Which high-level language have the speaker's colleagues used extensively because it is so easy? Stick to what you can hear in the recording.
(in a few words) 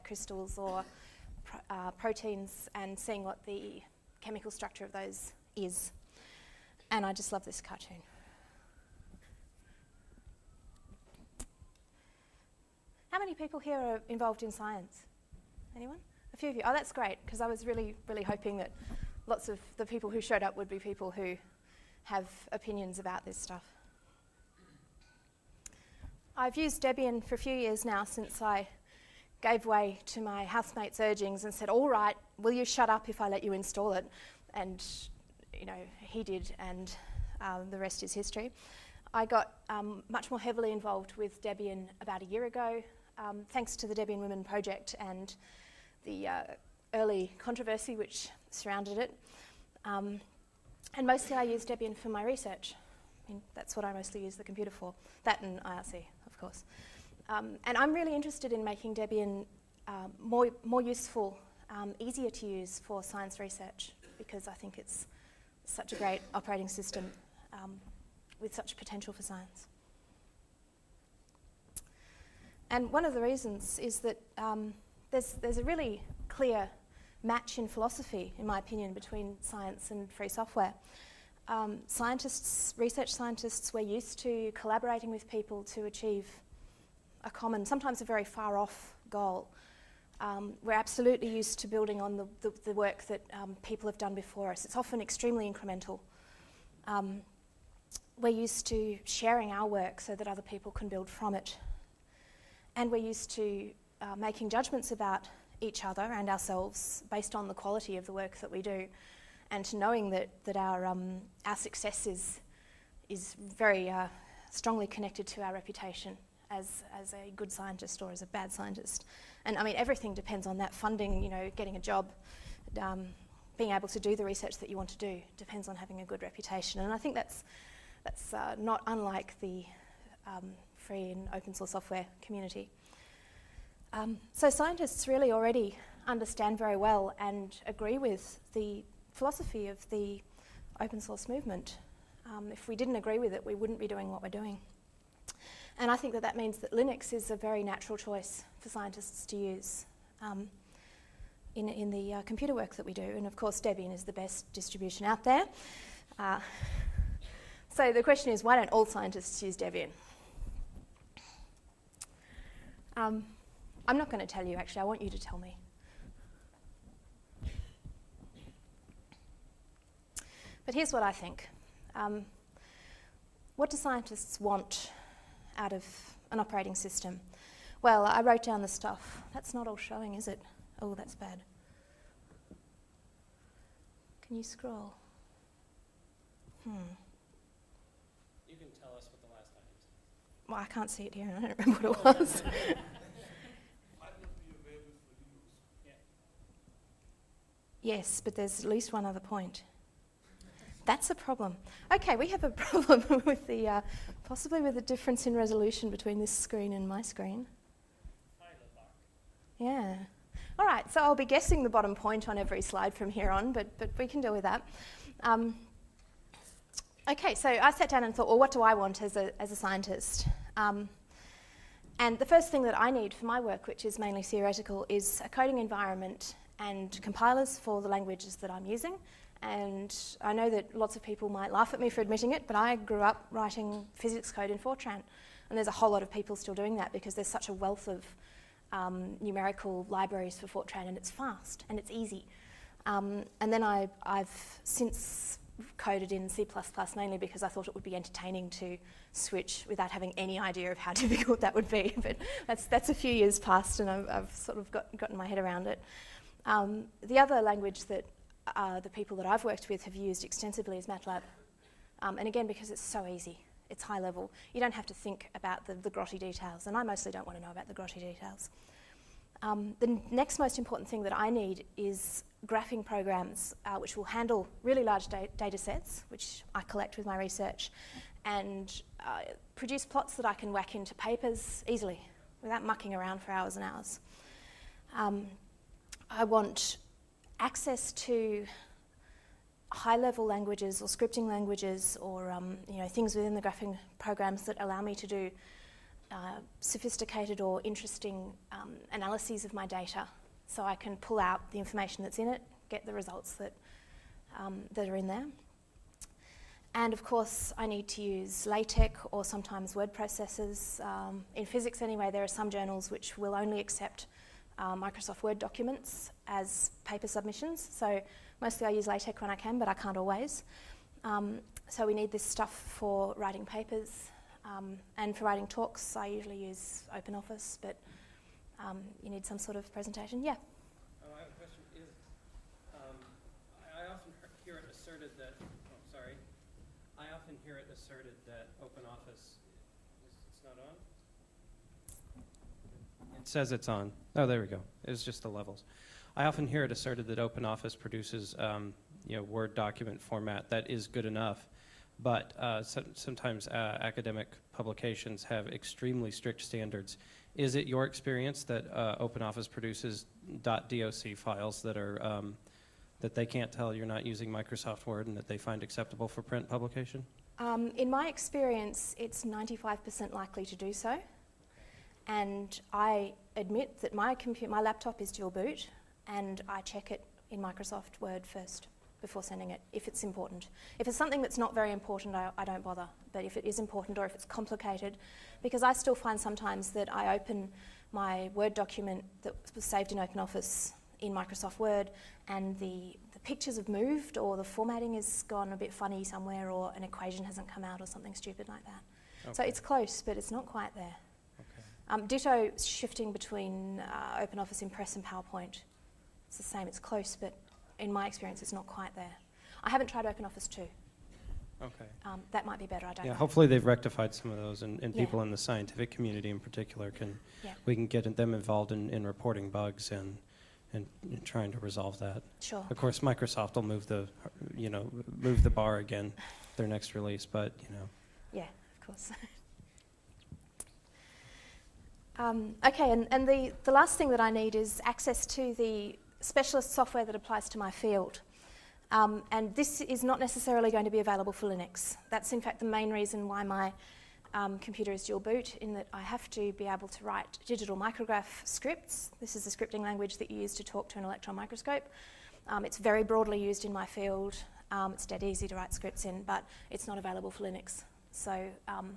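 MATLAB.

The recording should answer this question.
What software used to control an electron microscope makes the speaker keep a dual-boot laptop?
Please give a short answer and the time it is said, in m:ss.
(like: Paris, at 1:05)
Digital Micrograph, at 7:27.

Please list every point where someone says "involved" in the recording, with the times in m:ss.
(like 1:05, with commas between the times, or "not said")
0:14, 0:40, 6:58.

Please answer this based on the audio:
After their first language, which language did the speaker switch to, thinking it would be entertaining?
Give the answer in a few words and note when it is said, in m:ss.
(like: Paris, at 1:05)
C++, at 4:06.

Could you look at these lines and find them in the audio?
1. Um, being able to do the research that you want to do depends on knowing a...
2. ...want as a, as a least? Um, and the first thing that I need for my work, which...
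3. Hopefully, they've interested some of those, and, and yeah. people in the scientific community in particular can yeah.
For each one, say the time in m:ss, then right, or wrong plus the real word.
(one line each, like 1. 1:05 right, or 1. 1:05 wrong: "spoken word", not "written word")
1. 2:02 wrong: "having", not "knowing"
2. 3:38 wrong: "scientist", not "least"
3. 6:53 wrong: "rectified", not "interested".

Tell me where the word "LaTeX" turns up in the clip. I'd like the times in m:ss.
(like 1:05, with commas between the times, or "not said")
5:08, 5:18.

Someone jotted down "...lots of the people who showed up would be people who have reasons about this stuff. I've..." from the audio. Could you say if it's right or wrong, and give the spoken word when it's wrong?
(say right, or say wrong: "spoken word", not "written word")
wrong: "opinions", not "reasons".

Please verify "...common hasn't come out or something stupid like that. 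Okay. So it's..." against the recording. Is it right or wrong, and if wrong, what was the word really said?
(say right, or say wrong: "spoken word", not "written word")
wrong: "equation", not "common".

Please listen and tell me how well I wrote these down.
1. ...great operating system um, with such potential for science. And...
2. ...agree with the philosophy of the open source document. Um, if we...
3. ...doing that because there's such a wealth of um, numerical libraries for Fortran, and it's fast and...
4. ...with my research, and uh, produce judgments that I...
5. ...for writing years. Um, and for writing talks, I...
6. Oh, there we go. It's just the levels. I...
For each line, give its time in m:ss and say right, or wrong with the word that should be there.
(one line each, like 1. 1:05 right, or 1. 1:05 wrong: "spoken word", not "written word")
1. 1:05 right
2. 2:17 wrong: "movement", not "document"
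3. 3:56 right
4. 4:36 wrong: "plots", not "judgments"
5. 5:22 wrong: "papers", not "years"
6. 5:44 right.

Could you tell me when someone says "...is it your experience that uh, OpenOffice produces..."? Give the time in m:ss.
5:57.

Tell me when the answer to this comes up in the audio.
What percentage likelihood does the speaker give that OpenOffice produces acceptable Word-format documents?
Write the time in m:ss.
6:09.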